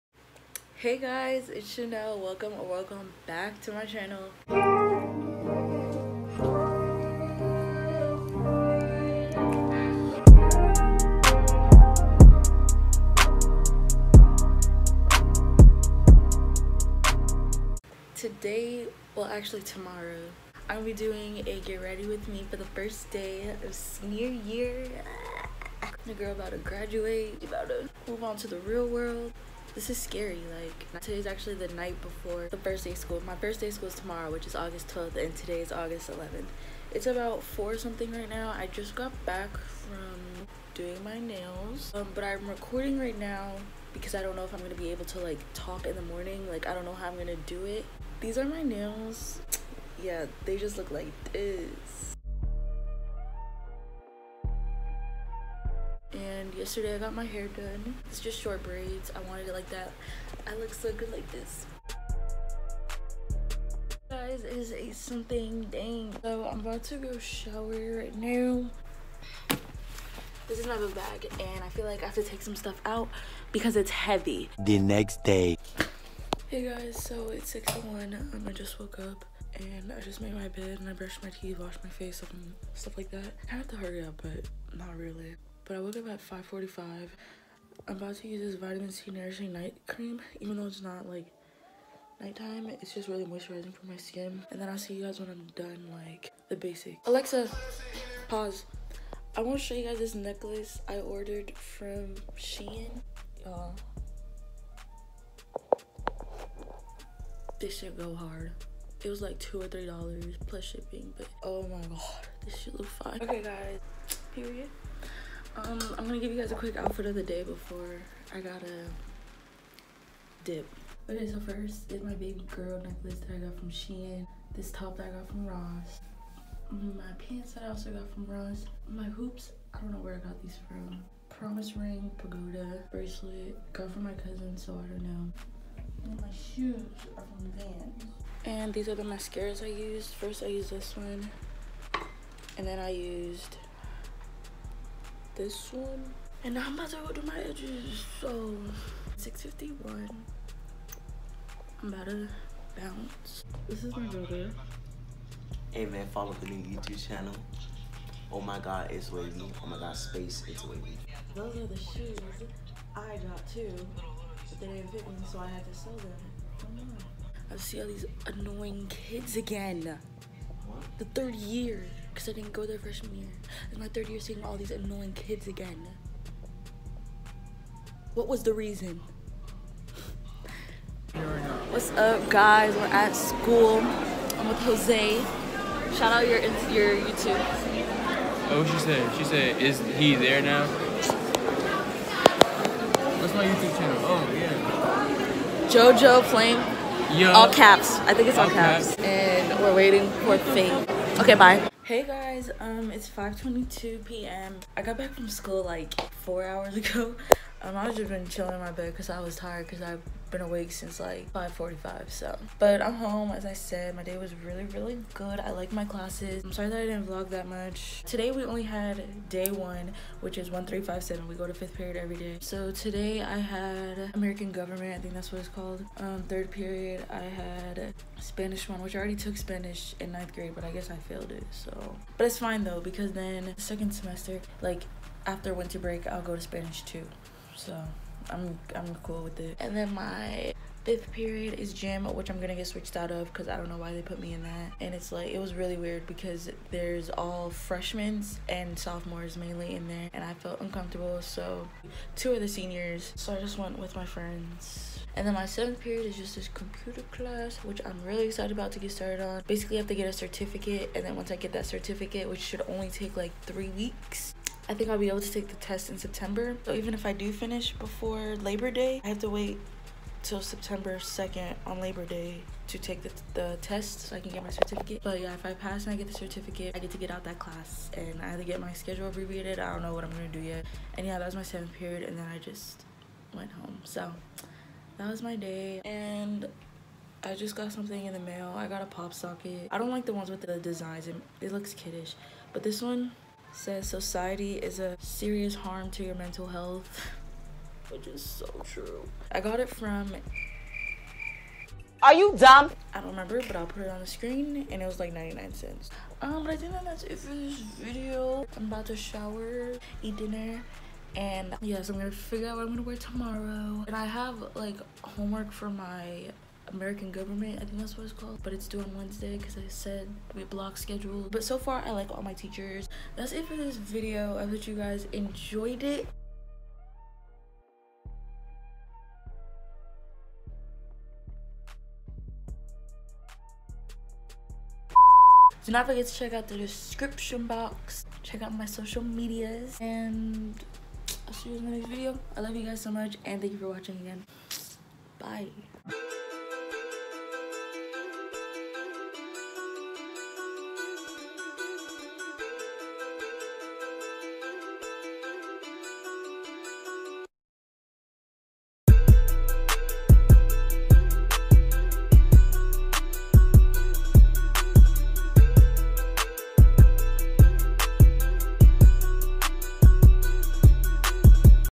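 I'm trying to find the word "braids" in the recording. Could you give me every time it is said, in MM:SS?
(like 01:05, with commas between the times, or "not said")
00:58.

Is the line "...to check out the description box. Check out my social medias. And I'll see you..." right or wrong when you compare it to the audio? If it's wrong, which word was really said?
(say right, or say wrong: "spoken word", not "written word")
right.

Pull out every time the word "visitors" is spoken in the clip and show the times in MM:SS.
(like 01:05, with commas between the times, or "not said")
not said.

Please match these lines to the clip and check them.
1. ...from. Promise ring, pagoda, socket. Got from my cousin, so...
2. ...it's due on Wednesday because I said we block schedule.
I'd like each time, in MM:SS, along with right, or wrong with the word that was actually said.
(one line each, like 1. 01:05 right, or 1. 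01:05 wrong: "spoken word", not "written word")
1. 02:10 wrong: "bracelet", not "socket"
2. 05:18 right.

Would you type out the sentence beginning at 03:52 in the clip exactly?
But it's fine though, because then second semester, like after winter break, I'll go to Spanish two.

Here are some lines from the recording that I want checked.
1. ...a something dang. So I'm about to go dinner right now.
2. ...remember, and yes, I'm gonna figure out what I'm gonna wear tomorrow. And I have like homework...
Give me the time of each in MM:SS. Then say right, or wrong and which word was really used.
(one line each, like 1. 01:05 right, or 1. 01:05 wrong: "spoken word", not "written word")
1. 01:04 wrong: "shower", not "dinner"
2. 05:10 wrong: "dinner", not "remember".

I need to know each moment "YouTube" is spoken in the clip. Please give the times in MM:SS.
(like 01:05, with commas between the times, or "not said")
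02:36, 03:06, 03:13.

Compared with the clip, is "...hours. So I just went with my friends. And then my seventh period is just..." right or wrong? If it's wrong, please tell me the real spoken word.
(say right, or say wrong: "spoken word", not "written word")
wrong: "seniors", not "hours".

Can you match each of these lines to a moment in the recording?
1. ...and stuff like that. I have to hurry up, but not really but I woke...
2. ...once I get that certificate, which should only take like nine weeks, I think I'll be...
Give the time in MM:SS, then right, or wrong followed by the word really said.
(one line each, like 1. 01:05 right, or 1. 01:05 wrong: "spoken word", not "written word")
1. 01:22 right
2. 04:21 wrong: "three", not "nine".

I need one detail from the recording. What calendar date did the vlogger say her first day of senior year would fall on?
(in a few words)
August 12th.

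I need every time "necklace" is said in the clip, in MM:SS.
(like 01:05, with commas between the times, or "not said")
01:40, 02:02.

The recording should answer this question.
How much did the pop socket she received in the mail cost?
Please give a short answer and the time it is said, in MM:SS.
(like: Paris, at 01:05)
99 cents, at 05:05.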